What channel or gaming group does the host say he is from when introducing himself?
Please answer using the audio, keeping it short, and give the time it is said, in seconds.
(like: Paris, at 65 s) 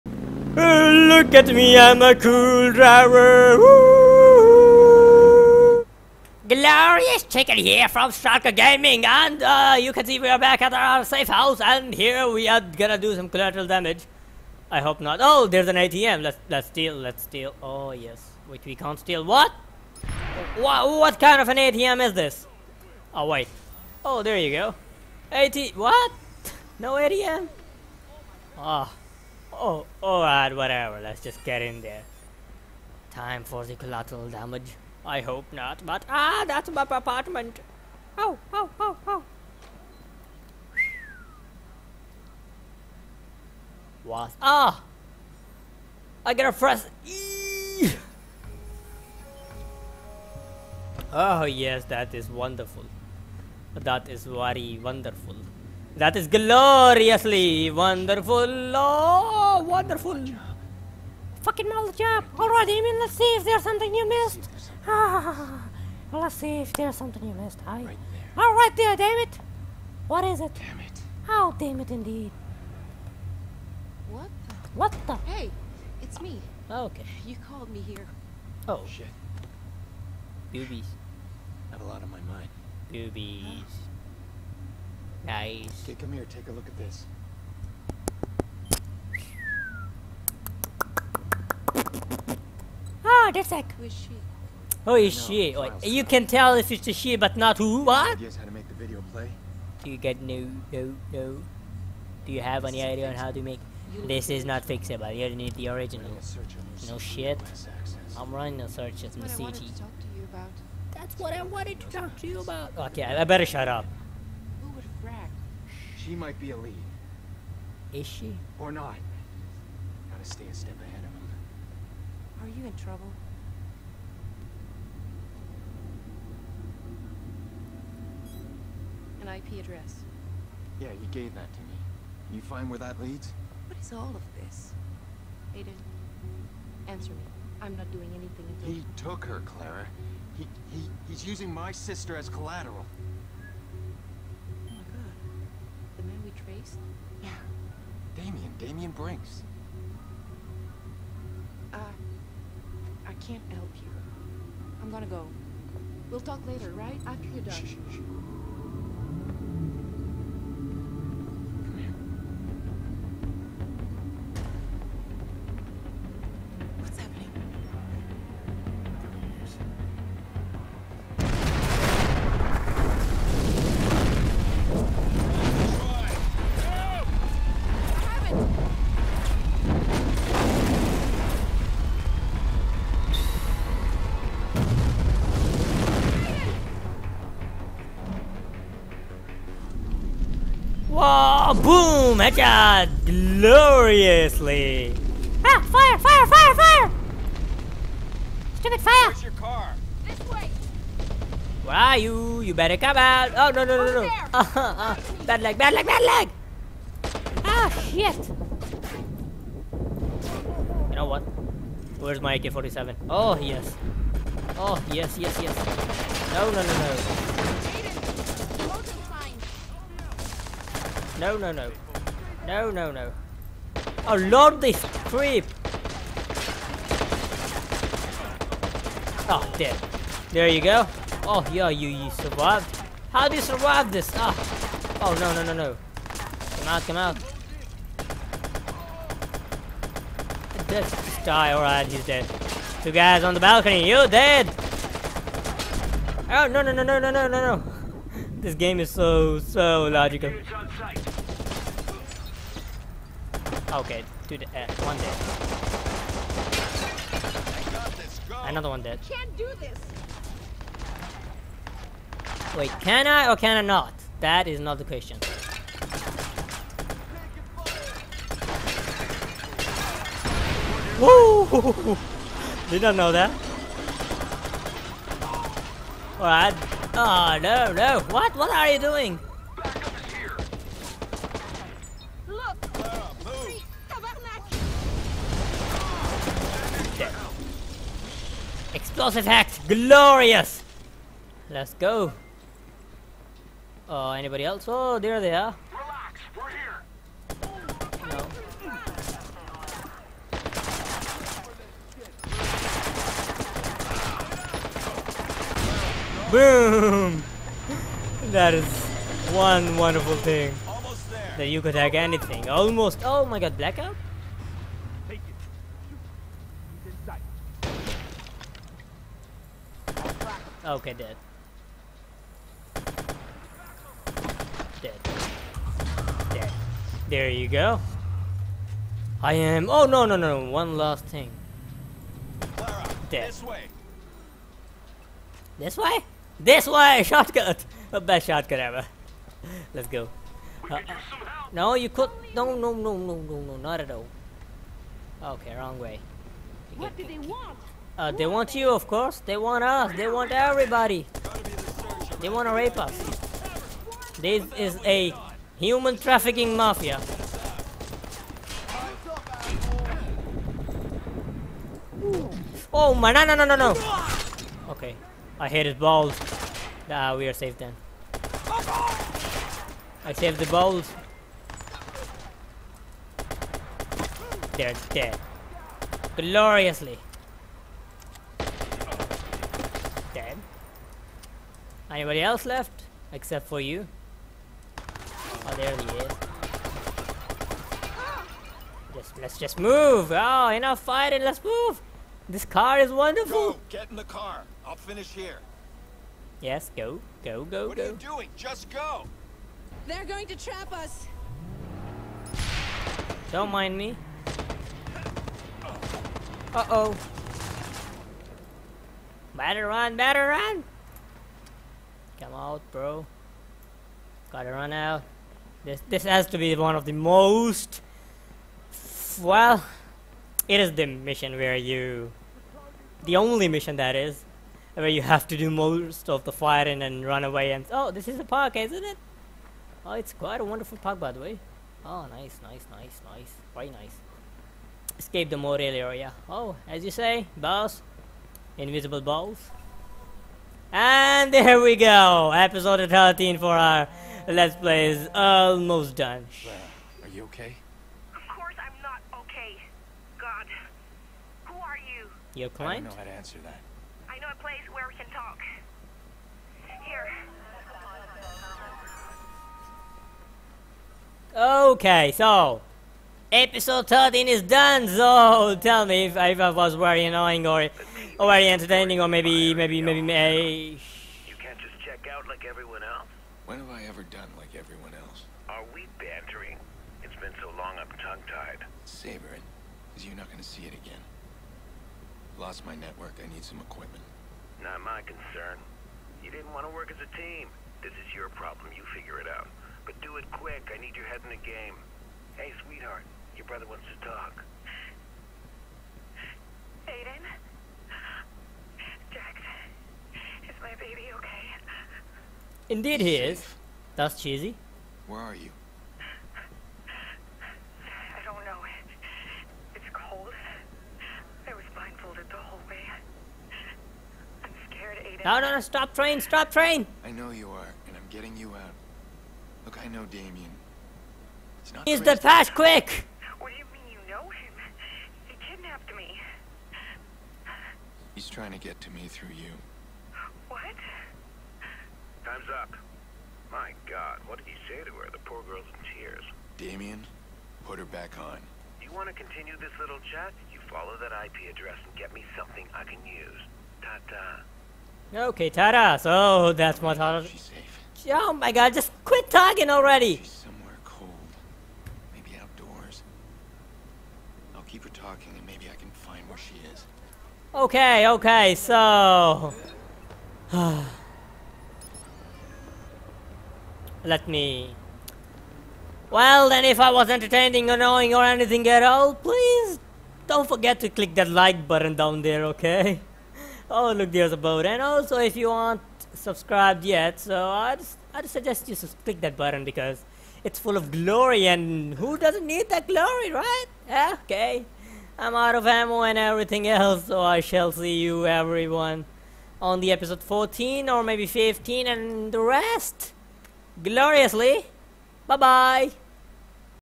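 Stalker Gaming, at 8 s.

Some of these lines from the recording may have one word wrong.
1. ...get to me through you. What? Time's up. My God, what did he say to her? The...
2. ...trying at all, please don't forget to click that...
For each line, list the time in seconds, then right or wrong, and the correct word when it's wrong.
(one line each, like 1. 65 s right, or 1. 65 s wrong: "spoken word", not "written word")
1. 528 s right
2. 568 s wrong: "anything", not "trying".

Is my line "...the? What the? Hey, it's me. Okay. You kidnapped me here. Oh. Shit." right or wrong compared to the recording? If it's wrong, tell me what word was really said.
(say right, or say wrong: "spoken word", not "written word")
wrong: "called", not "kidnapped".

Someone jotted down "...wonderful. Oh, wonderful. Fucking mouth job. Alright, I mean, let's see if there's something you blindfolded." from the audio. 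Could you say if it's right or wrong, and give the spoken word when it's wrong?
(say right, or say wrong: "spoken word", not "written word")
wrong: "missed", not "blindfolded".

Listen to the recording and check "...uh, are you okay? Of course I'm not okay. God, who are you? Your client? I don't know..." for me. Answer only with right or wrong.
right.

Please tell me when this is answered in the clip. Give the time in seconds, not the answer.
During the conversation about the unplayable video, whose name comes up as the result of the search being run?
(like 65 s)
109 s.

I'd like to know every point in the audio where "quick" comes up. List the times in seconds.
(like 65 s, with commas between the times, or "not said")
490 s, 522 s.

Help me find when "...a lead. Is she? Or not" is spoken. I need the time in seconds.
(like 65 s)
116 s.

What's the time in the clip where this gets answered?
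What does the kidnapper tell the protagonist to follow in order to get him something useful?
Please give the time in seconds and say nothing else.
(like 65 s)
541 s.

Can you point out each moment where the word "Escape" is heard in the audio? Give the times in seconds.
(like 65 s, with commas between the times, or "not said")
434 s.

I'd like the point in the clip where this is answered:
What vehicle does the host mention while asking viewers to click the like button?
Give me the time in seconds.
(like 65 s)
574 s.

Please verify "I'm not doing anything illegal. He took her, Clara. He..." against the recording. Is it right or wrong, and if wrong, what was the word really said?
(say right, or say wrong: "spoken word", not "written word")
right.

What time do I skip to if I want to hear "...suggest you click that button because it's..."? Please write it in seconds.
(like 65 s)
578 s.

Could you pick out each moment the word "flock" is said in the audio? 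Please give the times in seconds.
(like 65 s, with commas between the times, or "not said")
not said.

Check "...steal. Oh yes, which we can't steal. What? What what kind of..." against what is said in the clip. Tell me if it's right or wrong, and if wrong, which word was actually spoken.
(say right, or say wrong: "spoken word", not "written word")
right.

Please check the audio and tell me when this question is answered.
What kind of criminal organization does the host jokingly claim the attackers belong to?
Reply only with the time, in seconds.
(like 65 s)
355 s.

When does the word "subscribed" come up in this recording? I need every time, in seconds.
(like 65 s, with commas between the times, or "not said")
576 s.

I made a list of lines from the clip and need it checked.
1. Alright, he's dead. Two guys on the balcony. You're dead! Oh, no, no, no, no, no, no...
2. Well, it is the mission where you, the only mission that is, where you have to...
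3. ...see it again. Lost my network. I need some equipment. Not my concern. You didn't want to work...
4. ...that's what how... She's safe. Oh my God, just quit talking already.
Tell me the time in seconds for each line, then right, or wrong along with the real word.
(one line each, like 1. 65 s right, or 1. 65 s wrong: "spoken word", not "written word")
1. 241 s right
2. 419 s right
3. 480 s right
4. 546 s right.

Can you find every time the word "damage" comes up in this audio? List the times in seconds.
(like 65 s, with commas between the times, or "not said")
13 s, 34 s.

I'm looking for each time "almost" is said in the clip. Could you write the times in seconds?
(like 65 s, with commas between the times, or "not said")
312 s, 445 s.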